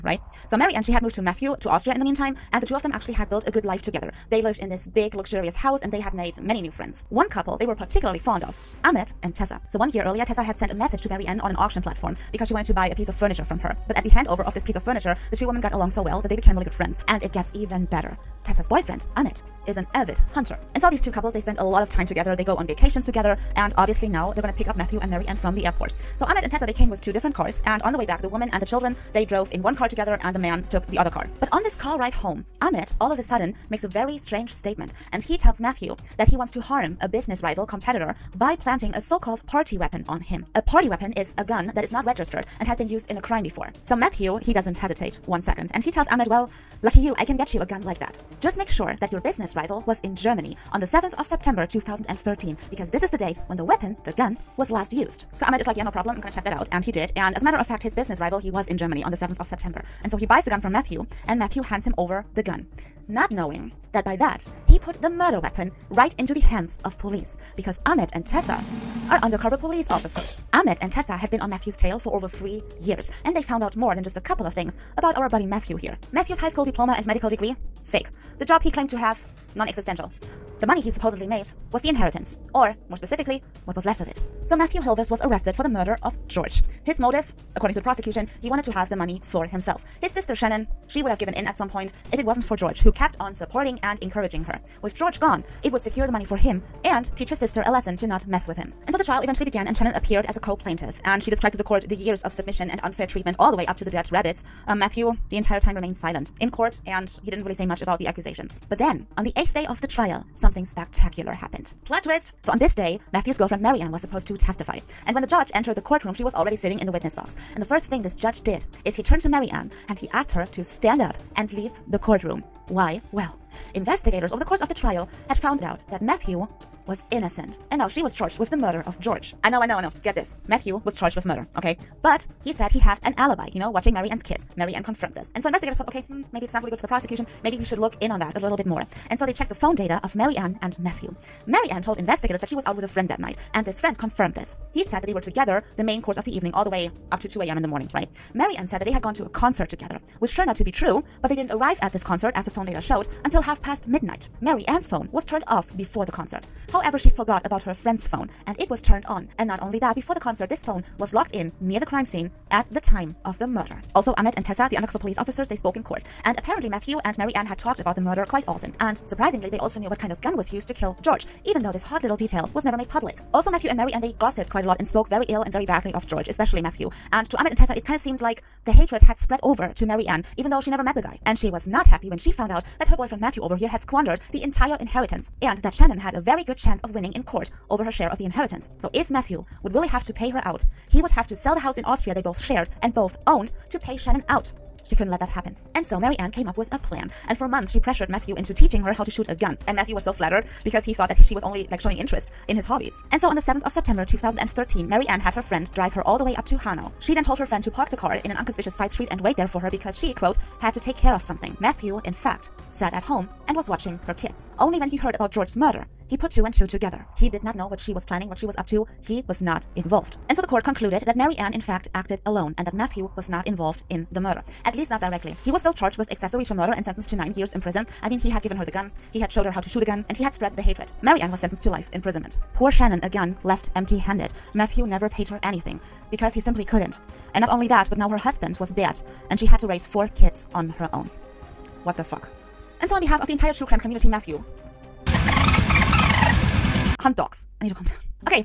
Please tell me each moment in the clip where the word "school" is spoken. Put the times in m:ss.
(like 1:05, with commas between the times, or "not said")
1:16.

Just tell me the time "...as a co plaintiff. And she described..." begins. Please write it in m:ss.
1:40.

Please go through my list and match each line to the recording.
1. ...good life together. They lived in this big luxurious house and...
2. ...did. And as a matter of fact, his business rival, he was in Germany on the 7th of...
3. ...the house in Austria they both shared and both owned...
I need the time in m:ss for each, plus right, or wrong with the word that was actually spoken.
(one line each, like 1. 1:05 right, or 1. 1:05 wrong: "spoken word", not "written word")
1. 0:03 right
2. 0:56 right
3. 3:11 right.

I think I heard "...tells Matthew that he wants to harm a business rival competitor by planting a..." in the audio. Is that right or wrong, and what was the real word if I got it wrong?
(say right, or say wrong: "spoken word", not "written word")
right.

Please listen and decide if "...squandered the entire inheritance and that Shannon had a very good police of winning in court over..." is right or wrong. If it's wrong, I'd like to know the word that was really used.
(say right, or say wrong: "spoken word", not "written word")
wrong: "chance", not "police".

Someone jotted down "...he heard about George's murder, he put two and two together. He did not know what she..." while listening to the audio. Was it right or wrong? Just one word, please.
right.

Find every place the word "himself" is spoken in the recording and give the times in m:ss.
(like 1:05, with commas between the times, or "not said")
1:29.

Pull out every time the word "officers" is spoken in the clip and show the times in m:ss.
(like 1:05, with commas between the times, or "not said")
1:09, 2:45.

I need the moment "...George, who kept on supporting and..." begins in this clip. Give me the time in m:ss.
1:32.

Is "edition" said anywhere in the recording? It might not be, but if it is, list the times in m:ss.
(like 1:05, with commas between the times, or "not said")
not said.